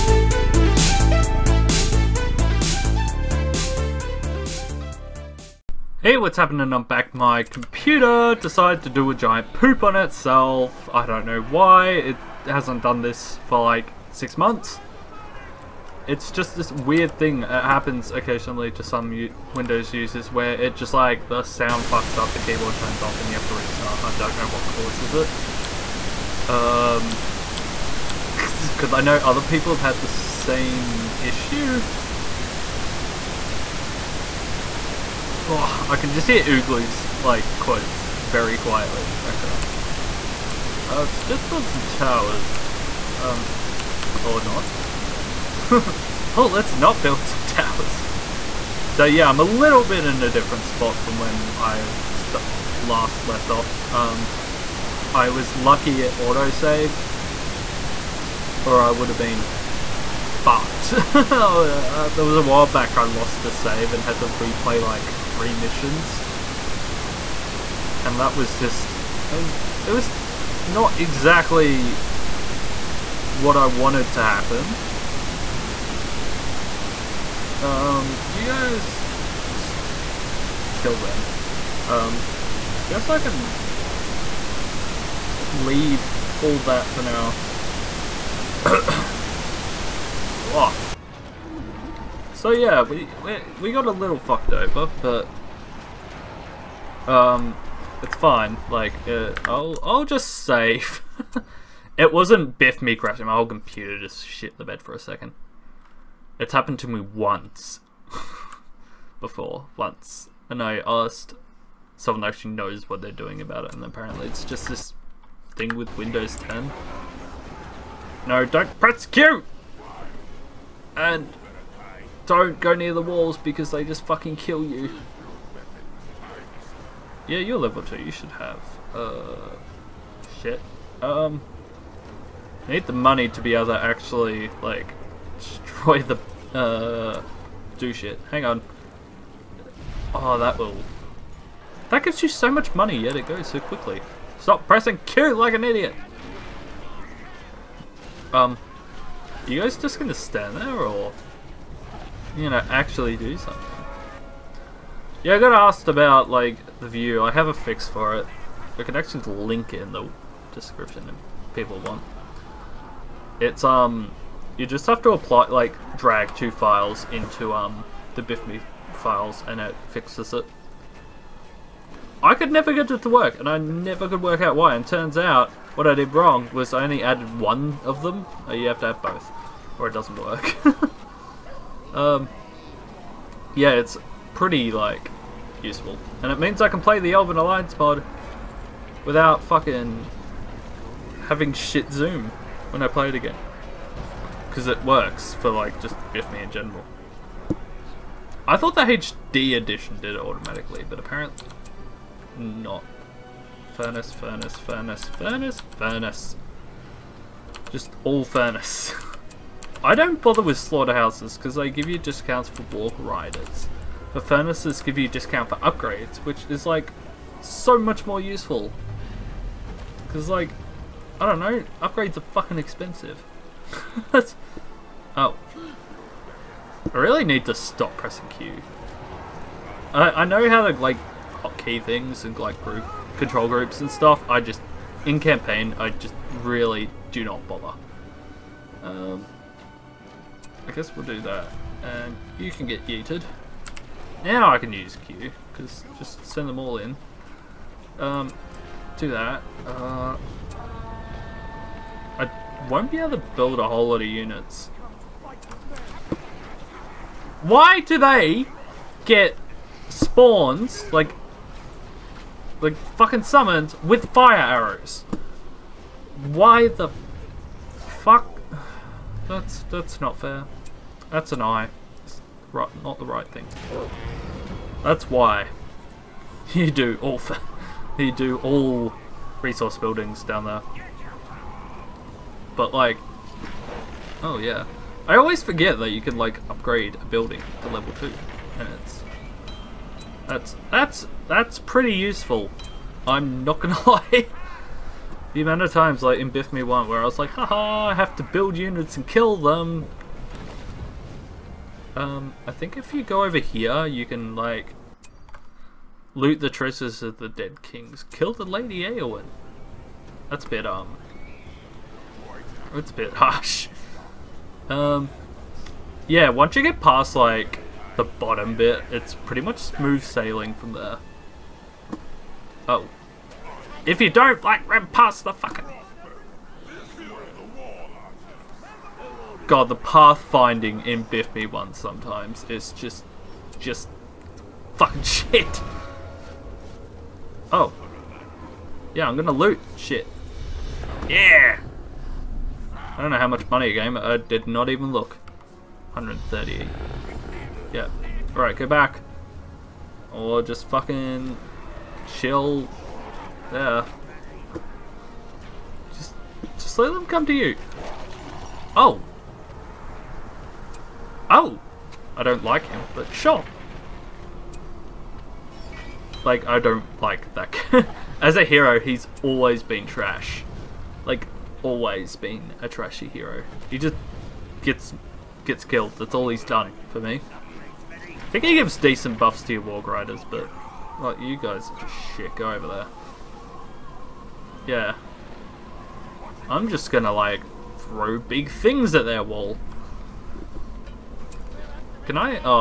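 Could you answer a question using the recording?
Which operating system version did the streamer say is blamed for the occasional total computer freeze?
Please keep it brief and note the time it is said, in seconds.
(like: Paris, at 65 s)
Windows 10, at 115 s.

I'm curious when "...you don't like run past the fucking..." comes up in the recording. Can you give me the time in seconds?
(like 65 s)
323 s.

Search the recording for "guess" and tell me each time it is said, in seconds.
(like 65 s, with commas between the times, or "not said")
82 s, 240 s.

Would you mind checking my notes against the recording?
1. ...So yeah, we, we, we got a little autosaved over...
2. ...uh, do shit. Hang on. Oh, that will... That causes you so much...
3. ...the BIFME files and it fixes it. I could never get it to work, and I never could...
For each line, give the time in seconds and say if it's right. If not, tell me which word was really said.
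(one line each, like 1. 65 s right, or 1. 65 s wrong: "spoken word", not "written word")
1. 92 s wrong: "fucked", not "autosaved"
2. 136 s wrong: "gives", not "causes"
3. 168 s right.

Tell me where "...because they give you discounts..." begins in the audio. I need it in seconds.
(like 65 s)
211 s.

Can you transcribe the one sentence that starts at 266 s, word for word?
Why the that's that's not fair.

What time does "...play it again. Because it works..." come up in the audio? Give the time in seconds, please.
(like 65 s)
192 s.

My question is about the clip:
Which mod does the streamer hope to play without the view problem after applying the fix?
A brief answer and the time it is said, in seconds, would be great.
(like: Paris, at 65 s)
Elven Alliance, at 187 s.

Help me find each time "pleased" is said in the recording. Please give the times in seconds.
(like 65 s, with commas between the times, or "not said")
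not said.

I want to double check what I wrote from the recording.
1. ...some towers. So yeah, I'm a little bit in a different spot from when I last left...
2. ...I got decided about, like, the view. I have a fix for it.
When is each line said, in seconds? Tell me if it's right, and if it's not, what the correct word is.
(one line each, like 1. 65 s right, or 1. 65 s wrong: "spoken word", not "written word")
1. 47 s right
2. 155 s wrong: "asked", not "decided".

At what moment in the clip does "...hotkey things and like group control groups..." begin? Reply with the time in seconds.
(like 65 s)
231 s.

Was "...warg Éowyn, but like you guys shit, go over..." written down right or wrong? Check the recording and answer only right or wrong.
wrong.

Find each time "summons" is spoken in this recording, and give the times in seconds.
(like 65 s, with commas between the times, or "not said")
263 s.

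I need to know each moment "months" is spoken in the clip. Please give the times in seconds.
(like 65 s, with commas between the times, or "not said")
14 s.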